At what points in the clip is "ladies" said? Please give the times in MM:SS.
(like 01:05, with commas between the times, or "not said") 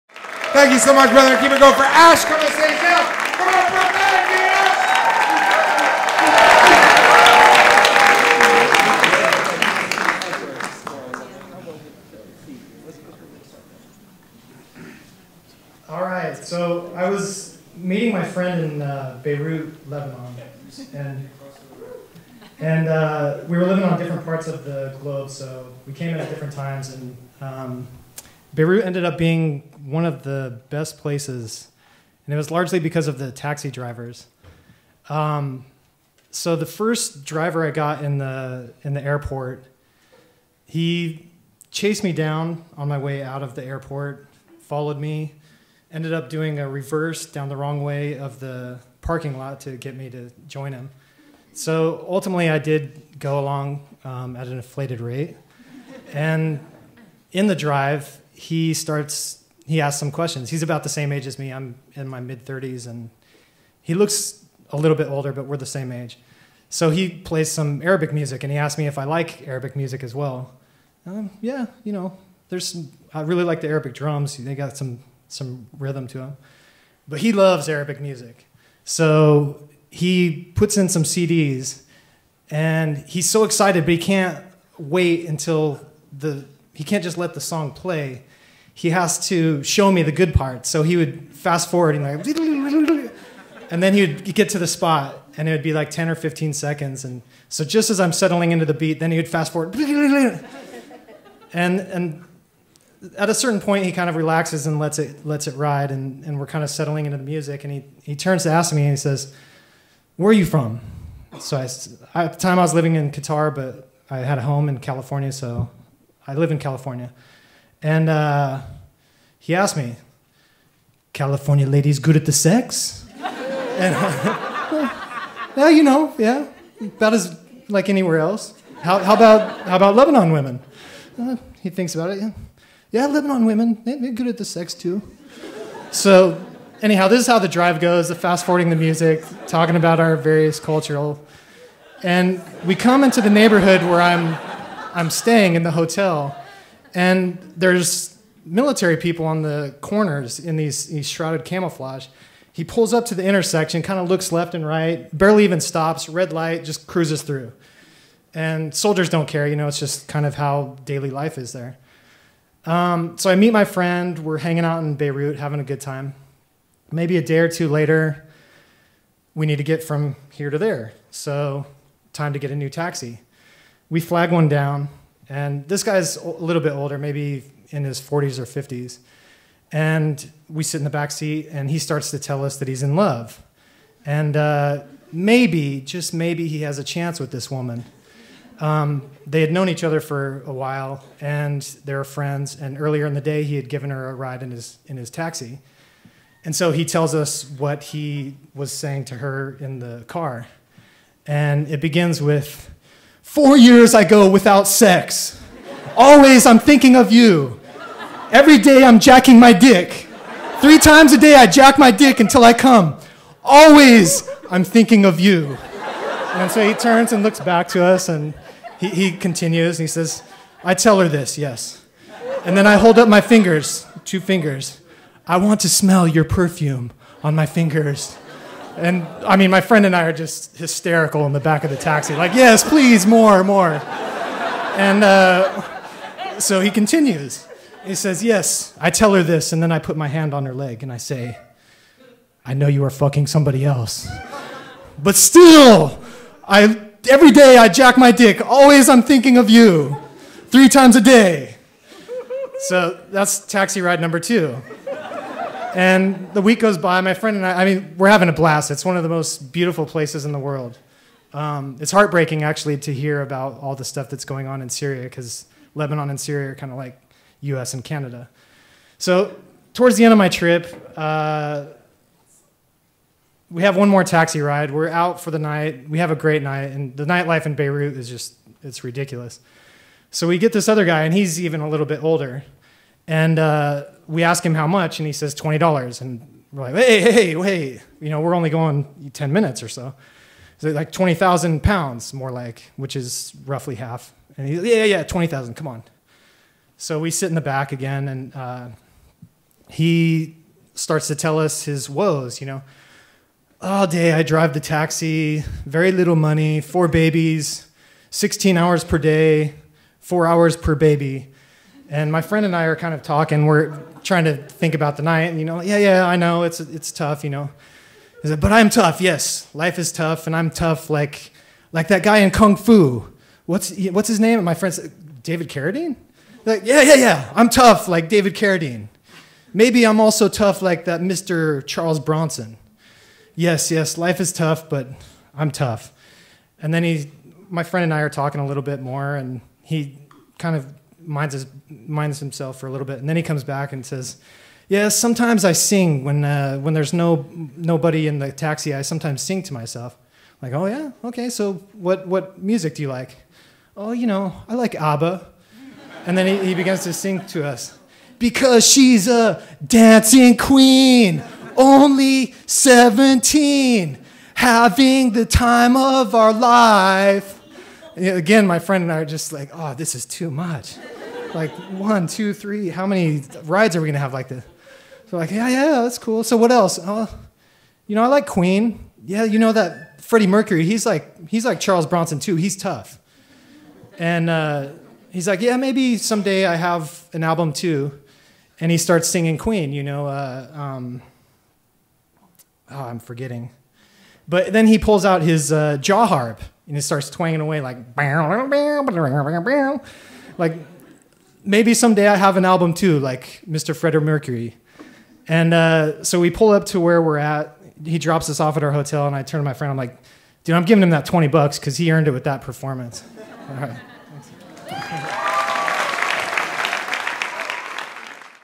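02:01.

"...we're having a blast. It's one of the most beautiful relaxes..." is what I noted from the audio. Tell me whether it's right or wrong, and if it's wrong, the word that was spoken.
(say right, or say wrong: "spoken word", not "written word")
wrong: "places", not "relaxes".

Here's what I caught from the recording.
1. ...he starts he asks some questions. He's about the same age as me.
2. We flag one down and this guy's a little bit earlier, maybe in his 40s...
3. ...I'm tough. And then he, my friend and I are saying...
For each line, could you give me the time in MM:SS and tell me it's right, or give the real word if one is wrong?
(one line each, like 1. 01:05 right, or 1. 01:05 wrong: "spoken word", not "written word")
1. 00:58 right
2. 02:53 wrong: "older", not "earlier"
3. 05:35 wrong: "talking", not "saying".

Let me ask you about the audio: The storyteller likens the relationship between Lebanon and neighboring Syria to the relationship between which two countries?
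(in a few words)
US and Canada.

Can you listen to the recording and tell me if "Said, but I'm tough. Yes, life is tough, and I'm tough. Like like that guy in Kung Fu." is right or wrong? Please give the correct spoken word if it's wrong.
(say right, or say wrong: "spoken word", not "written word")
right.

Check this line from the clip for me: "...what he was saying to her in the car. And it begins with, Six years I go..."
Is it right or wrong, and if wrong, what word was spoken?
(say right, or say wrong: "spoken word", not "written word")
wrong: "Four", not "Six".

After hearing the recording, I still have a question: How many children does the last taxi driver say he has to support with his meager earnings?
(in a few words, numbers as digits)
4.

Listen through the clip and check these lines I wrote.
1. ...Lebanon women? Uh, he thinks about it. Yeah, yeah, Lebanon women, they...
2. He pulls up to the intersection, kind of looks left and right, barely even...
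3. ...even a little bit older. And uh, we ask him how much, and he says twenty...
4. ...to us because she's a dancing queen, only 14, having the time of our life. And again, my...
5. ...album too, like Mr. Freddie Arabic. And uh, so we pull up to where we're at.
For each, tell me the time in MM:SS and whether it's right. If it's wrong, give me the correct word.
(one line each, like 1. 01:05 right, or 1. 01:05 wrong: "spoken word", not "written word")
1. 02:09 right
2. 02:32 right
3. 04:41 right
4. 05:57 wrong: "17", not "14"
5. 06:42 wrong: "Mercury", not "Arabic".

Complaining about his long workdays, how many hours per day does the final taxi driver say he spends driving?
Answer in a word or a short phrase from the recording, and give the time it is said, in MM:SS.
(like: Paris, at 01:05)
16, at 05:08.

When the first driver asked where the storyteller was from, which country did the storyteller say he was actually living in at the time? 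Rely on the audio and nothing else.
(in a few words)
Qatar.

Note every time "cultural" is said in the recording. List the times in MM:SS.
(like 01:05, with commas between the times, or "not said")
02:20.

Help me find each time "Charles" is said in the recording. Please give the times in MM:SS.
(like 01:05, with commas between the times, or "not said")
05:31, 06:21.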